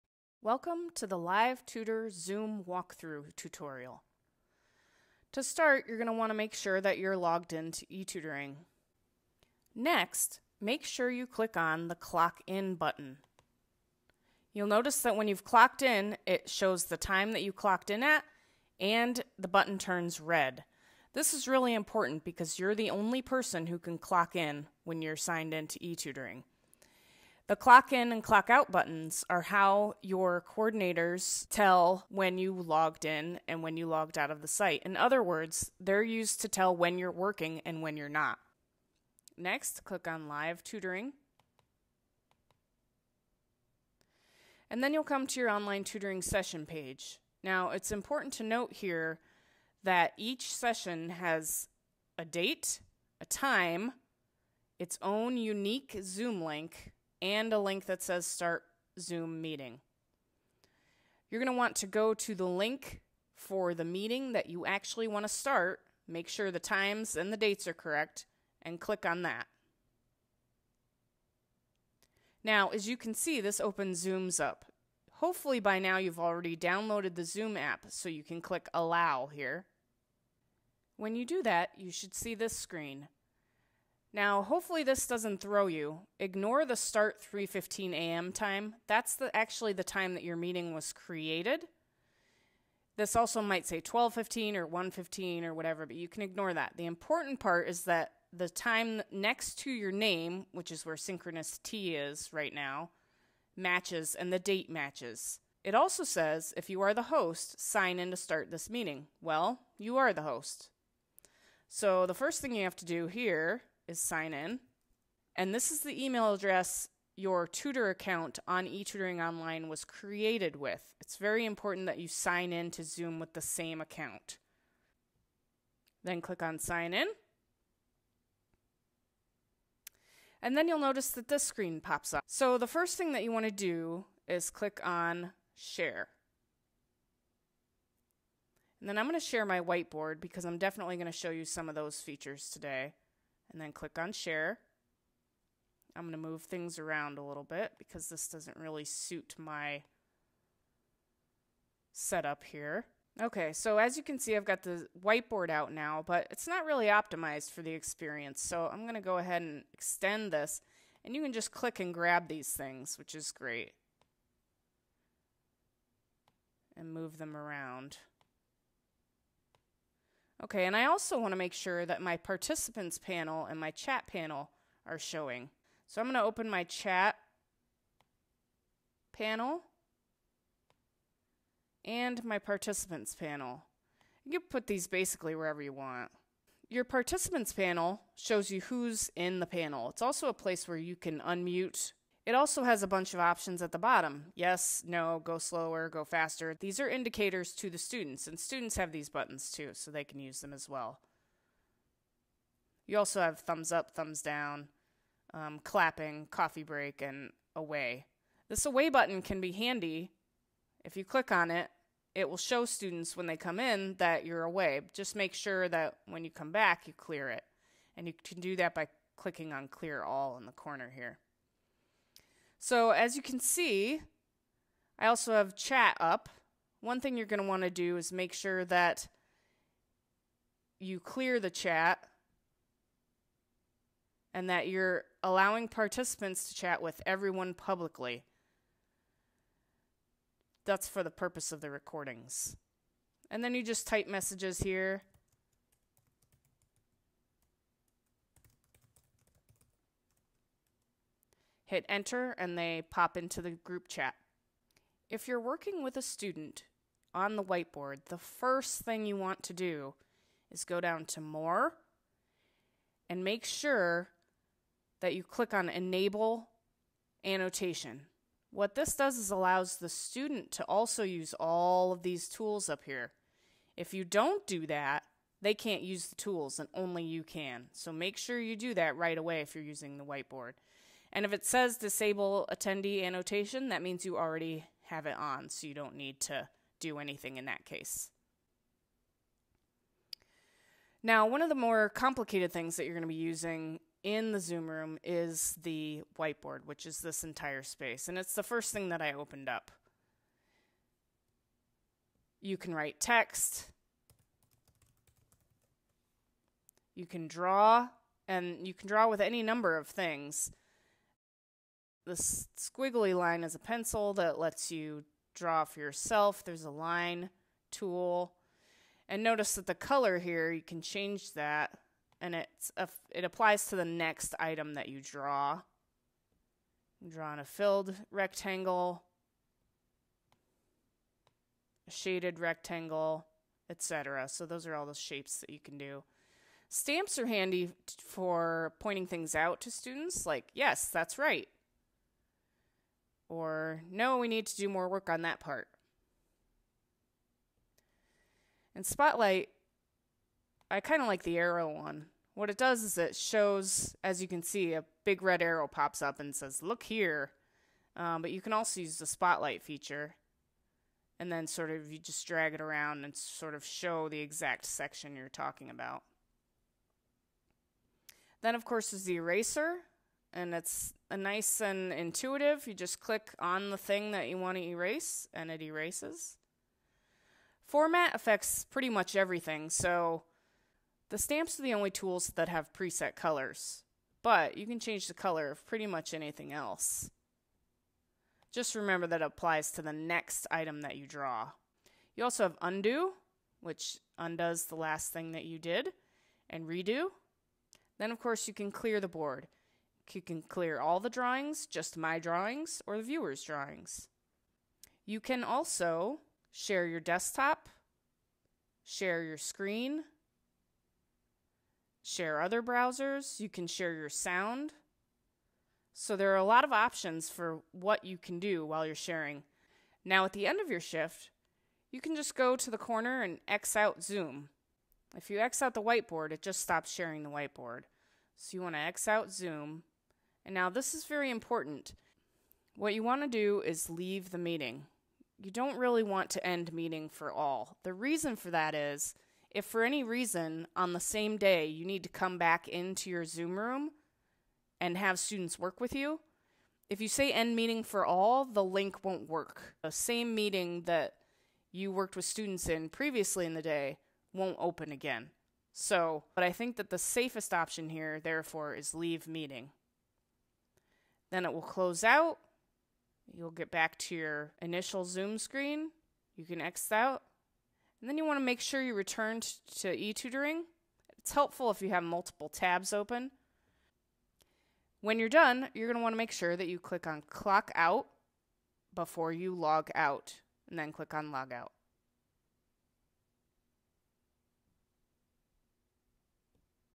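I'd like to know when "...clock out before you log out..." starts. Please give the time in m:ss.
7:57.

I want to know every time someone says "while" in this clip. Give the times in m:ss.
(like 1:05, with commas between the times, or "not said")
6:58.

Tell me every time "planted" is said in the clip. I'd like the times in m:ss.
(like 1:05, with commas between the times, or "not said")
not said.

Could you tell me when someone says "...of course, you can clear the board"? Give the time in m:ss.
6:38.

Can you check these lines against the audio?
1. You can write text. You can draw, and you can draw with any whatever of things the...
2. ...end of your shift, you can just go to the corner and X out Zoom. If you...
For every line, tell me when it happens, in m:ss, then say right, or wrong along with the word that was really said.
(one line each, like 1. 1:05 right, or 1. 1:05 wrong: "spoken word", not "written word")
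1. 5:02 wrong: "number", not "whatever"
2. 7:00 right.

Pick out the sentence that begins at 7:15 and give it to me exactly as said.
You don't really want to end meeting for all.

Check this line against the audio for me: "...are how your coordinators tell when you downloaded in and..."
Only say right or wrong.
wrong.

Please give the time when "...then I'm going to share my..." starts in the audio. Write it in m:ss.
2:18.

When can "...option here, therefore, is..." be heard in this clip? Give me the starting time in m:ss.
7:37.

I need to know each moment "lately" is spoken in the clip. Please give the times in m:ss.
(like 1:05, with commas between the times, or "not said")
not said.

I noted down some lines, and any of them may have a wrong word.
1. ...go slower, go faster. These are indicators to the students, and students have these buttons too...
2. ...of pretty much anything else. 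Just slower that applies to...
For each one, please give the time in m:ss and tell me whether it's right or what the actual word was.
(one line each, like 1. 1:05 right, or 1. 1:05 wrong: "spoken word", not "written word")
1. 3:15 right
2. 6:25 wrong: "remember", not "slower".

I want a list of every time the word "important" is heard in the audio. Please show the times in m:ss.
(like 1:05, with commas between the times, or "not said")
0:21, 0:47, 1:36, 2:01, 7:11.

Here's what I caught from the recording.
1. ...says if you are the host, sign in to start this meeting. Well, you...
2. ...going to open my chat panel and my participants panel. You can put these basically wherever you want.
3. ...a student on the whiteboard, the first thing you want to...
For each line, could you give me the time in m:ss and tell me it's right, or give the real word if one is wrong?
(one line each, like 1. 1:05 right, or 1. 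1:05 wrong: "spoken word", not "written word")
1. 1:46 right
2. 2:56 right
3. 4:15 right.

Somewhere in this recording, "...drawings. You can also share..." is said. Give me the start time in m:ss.
6:43.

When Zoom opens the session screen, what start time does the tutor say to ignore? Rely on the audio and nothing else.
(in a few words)
3:15 a.m.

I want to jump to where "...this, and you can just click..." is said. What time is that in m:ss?
2:40.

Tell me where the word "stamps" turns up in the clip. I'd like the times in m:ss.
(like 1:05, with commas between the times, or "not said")
5:36, 6:21.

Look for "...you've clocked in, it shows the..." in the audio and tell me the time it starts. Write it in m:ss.
0:15.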